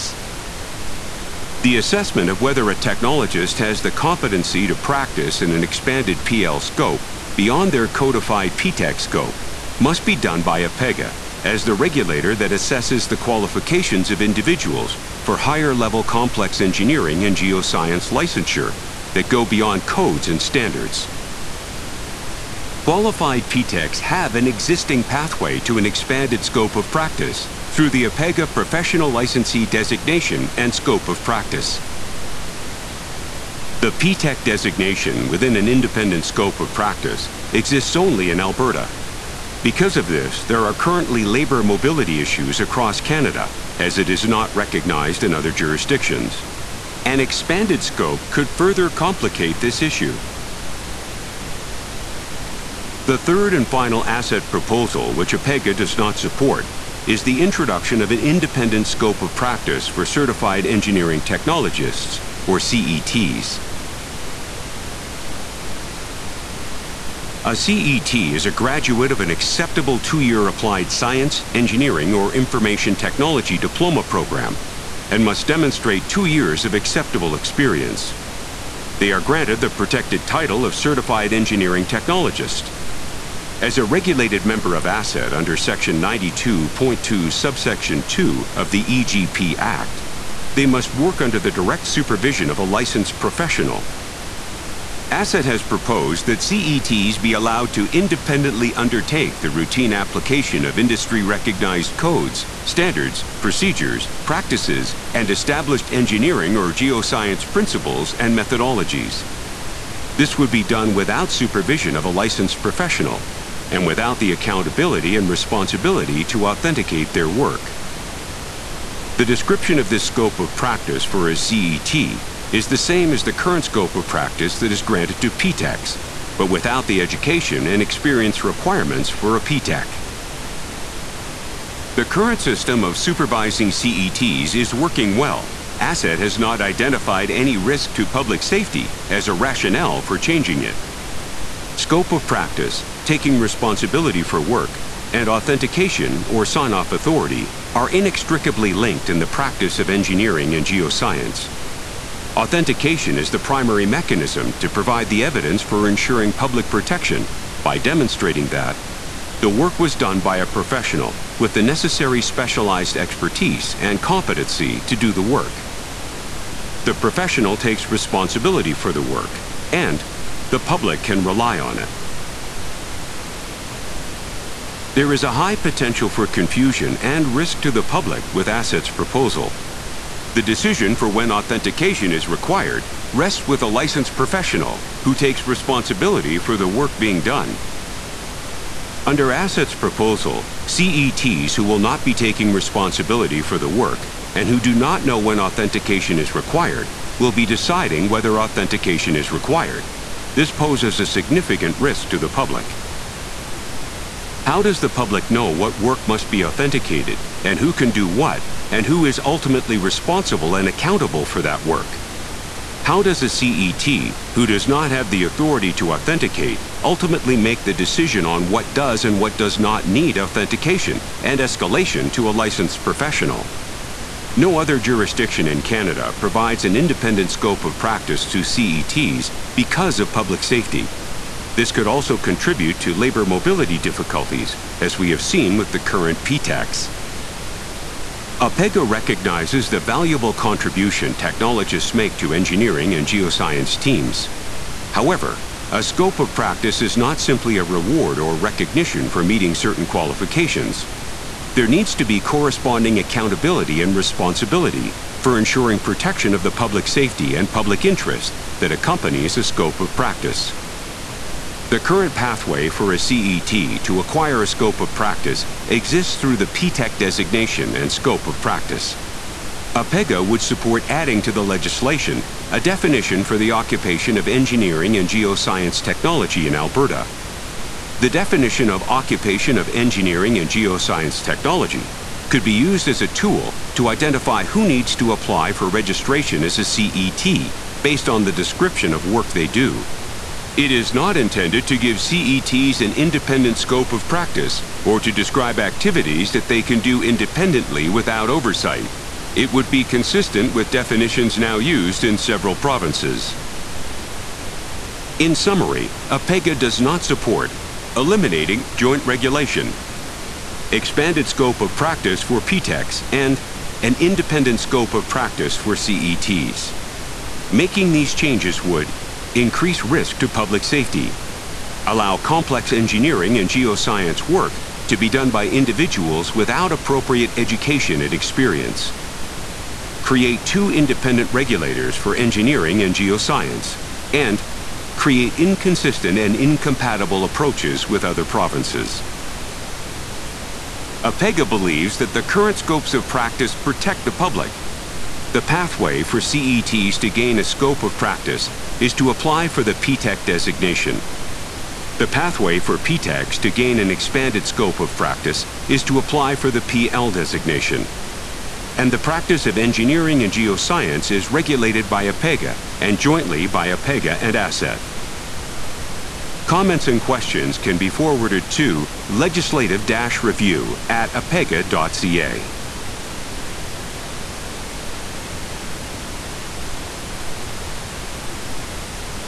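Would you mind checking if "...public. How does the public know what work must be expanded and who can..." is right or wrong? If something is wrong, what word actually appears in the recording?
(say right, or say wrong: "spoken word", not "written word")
wrong: "authenticated", not "expanded".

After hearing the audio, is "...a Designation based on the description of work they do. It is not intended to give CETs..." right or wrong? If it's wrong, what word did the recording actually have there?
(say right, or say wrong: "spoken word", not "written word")
wrong: "CET", not "Designation".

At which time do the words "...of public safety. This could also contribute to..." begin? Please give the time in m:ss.
3:49.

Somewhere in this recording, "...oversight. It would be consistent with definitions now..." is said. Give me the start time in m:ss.
4:58.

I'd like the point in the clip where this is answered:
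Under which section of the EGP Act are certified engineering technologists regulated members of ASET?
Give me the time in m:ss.
1:25.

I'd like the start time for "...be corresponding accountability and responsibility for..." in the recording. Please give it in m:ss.
4:12.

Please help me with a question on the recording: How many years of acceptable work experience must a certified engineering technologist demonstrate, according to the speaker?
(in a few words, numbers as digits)
2.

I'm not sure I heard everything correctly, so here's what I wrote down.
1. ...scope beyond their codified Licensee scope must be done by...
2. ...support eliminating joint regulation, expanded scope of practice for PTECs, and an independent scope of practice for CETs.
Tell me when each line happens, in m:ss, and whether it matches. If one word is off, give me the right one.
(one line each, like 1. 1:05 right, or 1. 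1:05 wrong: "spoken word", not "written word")
1. 0:06 wrong: "PTEC", not "Licensee"
2. 5:07 right.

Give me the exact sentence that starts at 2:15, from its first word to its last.
ASET has not identified any risk to public safety as a rationale for changing it.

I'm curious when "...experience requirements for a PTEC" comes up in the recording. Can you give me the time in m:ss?
2:07.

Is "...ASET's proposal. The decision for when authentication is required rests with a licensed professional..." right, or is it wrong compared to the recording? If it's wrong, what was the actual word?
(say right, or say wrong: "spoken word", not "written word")
right.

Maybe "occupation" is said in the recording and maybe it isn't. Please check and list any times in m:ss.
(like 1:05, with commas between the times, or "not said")
4:33, 4:38.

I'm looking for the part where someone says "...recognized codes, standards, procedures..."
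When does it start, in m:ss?
1:41.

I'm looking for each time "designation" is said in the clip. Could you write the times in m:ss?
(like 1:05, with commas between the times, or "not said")
0:29, 0:34, 4:26, 5:50, 5:57.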